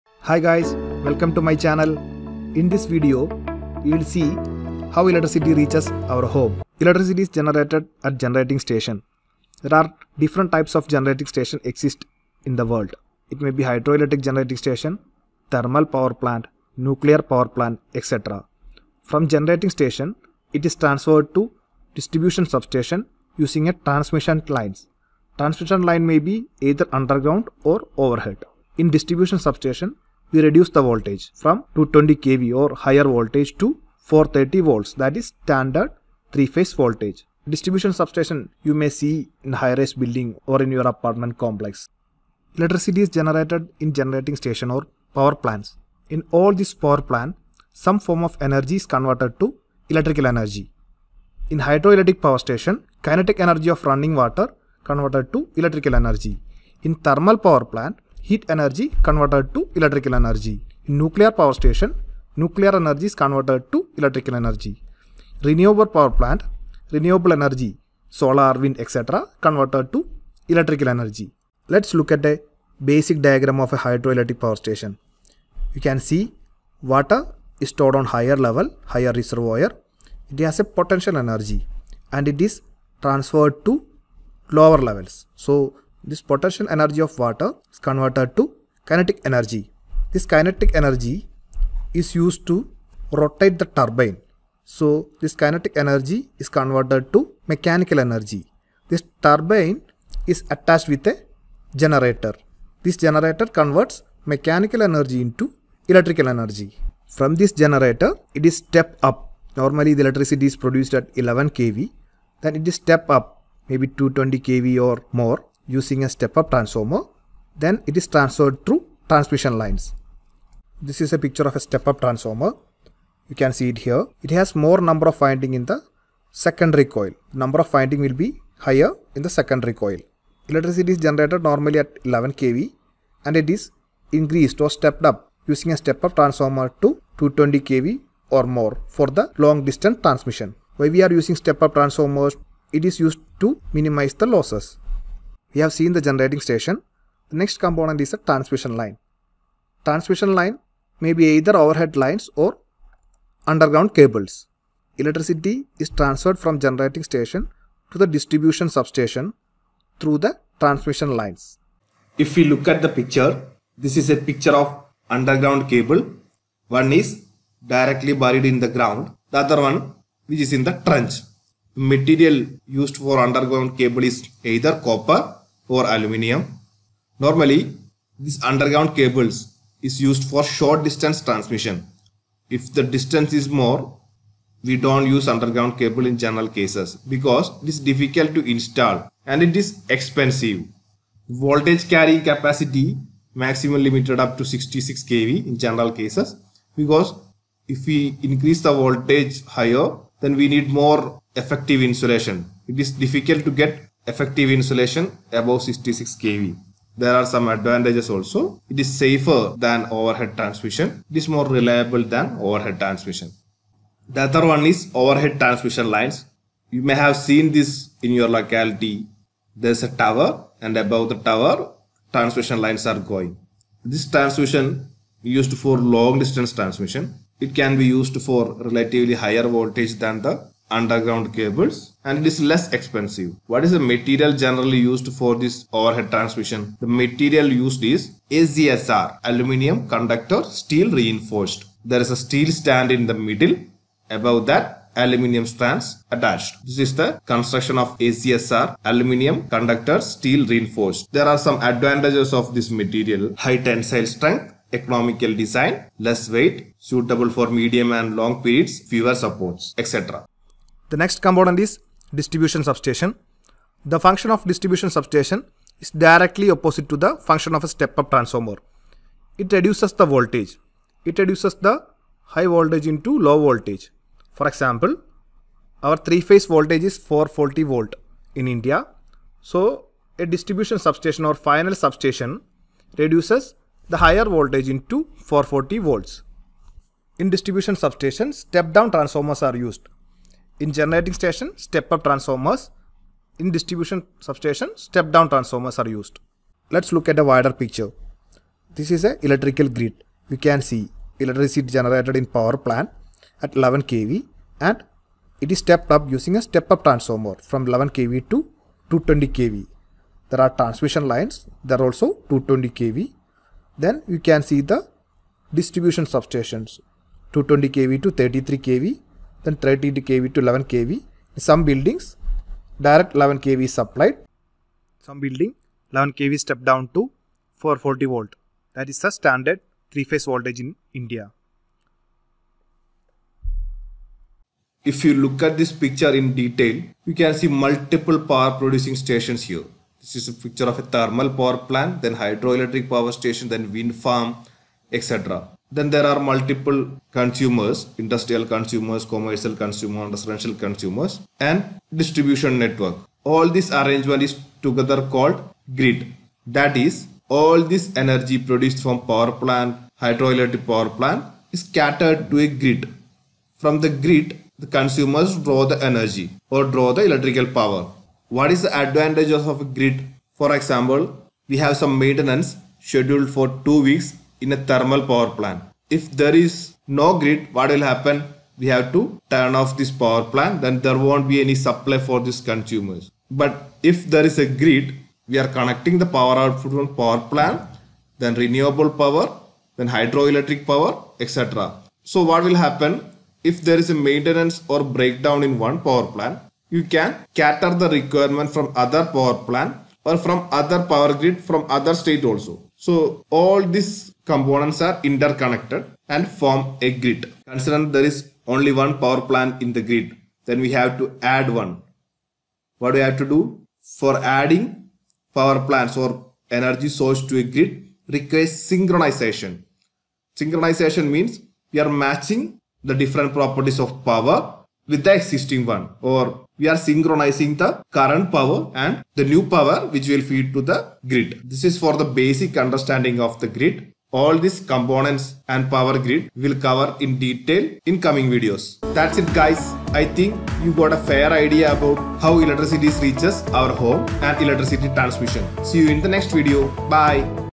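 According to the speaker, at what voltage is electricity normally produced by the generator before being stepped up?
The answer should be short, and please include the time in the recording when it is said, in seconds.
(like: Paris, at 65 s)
11 kV, at 109 s.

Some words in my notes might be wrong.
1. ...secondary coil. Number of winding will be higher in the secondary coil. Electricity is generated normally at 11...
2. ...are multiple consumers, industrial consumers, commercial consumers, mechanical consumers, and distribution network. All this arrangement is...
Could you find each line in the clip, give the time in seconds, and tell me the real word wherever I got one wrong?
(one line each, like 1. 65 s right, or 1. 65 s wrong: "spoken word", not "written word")
1. 126 s right
2. 346 s wrong: "residential", not "mechanical".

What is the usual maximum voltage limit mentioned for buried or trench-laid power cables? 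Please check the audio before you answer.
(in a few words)
66 kV.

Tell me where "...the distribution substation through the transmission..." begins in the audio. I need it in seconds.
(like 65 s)
157 s.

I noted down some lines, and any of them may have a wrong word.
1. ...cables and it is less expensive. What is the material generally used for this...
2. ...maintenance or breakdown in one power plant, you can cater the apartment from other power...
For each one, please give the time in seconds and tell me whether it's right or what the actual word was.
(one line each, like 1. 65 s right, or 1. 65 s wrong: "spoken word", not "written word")
1. 231 s right
2. 394 s wrong: "requirement", not "apartment".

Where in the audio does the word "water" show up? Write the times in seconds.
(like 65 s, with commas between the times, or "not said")
54 s, 76 s, 87 s.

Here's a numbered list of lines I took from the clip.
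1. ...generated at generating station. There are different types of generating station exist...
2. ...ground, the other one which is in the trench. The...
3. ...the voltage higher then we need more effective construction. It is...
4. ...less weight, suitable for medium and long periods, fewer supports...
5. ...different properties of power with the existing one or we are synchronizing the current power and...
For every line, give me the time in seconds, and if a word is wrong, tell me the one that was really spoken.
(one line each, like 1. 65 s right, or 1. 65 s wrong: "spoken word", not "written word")
1. 7 s right
2. 168 s right
3. 198 s wrong: "insulation", not "construction"
4. 255 s right
5. 422 s right.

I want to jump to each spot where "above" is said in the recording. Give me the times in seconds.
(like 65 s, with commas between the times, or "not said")
205 s, 220 s, 244 s.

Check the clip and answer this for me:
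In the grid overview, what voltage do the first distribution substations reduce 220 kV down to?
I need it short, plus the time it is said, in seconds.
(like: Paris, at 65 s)
33 kV, at 317 s.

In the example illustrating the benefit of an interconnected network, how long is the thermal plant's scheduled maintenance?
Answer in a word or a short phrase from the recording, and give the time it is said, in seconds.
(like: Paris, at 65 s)
2 weeks, at 373 s.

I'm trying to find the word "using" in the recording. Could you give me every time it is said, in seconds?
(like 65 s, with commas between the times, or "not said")
23 s, 115 s, 135 s, 141 s, 306 s.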